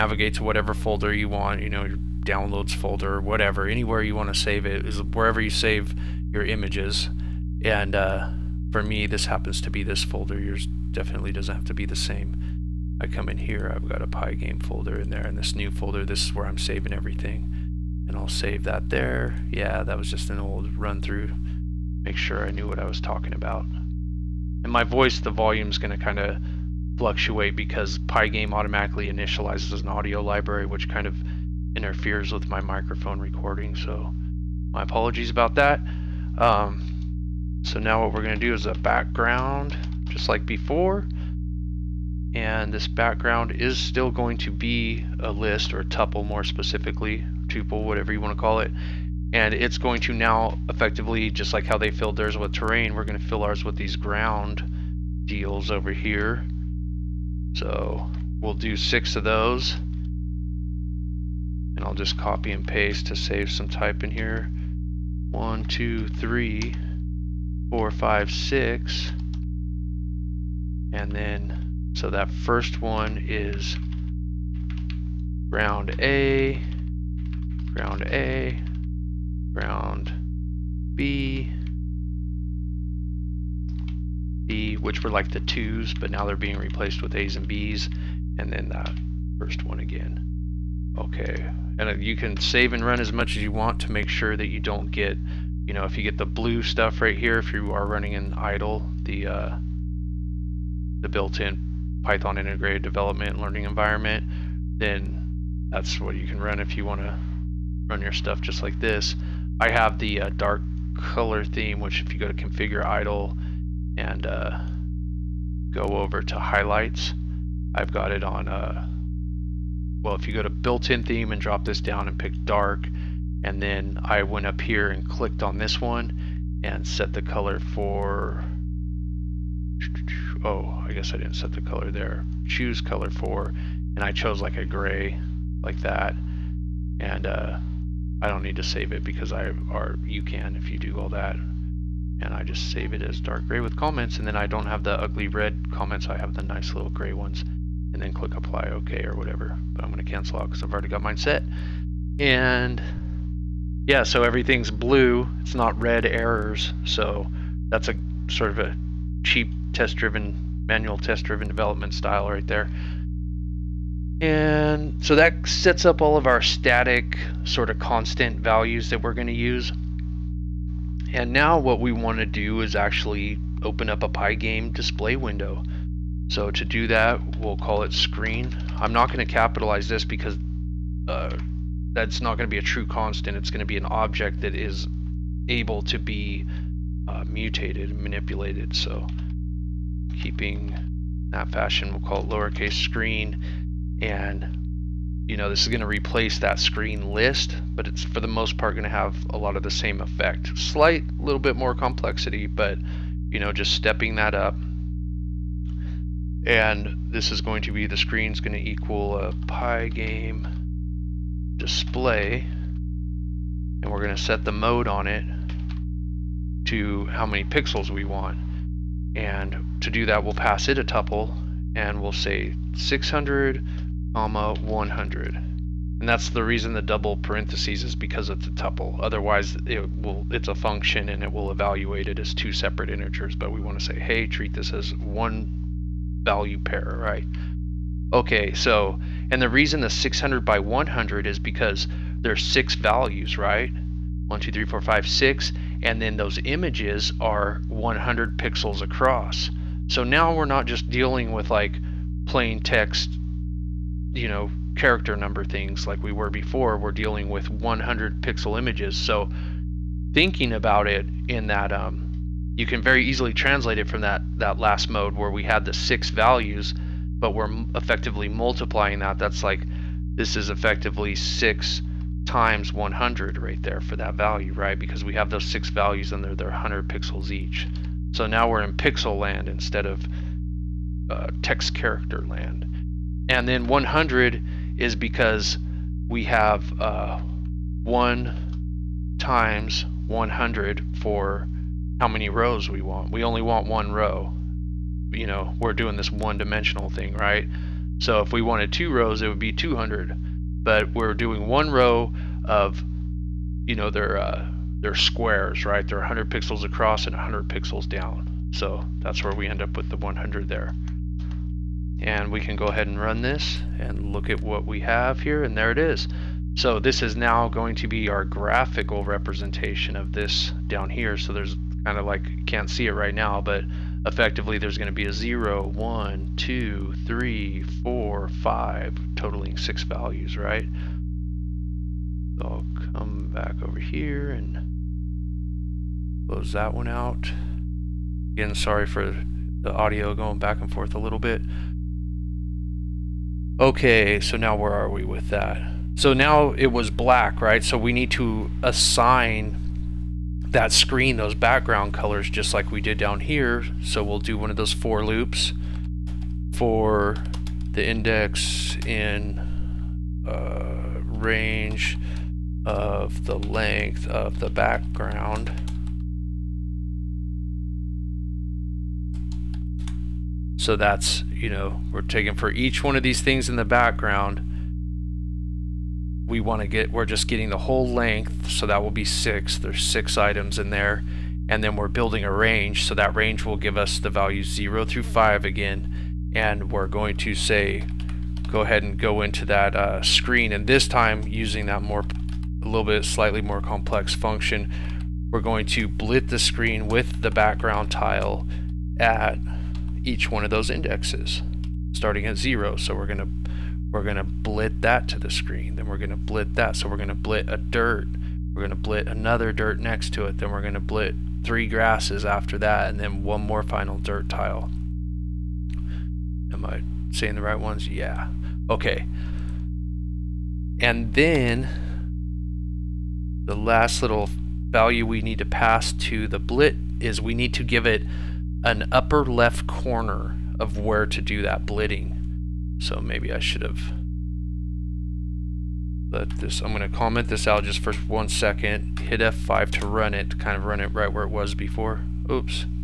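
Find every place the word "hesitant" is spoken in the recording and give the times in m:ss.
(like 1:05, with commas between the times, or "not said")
not said.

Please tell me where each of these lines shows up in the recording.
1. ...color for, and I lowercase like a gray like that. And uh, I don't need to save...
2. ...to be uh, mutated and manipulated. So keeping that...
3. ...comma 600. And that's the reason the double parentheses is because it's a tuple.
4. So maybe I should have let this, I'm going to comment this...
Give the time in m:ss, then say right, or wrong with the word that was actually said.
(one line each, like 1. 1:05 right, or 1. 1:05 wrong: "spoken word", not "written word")
1. 2:12 wrong: "chose", not "lowercase"
2. 3:05 right
3. 3:44 wrong: "100", not "600"
4. 7:12 right.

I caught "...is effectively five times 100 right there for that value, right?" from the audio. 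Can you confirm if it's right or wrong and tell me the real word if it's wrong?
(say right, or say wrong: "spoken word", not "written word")
wrong: "six", not "five".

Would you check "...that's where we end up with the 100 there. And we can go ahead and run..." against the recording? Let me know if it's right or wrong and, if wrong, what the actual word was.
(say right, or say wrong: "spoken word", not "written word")
right.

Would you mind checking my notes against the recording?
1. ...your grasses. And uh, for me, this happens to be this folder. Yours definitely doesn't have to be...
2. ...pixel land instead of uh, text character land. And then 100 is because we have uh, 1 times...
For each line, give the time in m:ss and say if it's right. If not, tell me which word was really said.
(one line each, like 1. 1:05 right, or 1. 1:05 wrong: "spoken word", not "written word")
1. 0:06 wrong: "images", not "grasses"
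2. 4:38 right.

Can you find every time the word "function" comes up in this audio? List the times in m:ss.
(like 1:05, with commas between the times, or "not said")
3:50, 6:34.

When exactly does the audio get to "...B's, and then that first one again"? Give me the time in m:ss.
1:27.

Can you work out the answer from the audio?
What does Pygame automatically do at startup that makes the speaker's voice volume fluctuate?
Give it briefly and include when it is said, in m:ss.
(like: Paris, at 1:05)
Initializes an audio library, at 0:29.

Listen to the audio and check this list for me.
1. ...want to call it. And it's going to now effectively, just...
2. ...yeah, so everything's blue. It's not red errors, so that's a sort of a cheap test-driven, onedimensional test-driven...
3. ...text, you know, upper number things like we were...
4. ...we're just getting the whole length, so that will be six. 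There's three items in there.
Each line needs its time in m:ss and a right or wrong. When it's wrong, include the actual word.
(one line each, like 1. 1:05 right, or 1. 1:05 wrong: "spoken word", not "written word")
1. 0:48 right
2. 2:33 wrong: "manual", not "onedimensional"
3. 4:12 wrong: "character", not "upper"
4. 6:16 wrong: "six", not "three".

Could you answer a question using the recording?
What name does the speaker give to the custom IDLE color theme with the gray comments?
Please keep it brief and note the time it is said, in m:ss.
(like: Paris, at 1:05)
Dark gray with comments, at 2:23.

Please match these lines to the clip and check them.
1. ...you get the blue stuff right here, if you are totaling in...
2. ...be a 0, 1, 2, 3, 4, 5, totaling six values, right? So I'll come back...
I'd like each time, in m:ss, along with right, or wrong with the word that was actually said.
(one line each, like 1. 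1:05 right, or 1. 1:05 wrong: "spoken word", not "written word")
1. 1:35 wrong: "running", not "totaling"
2. 5:24 right.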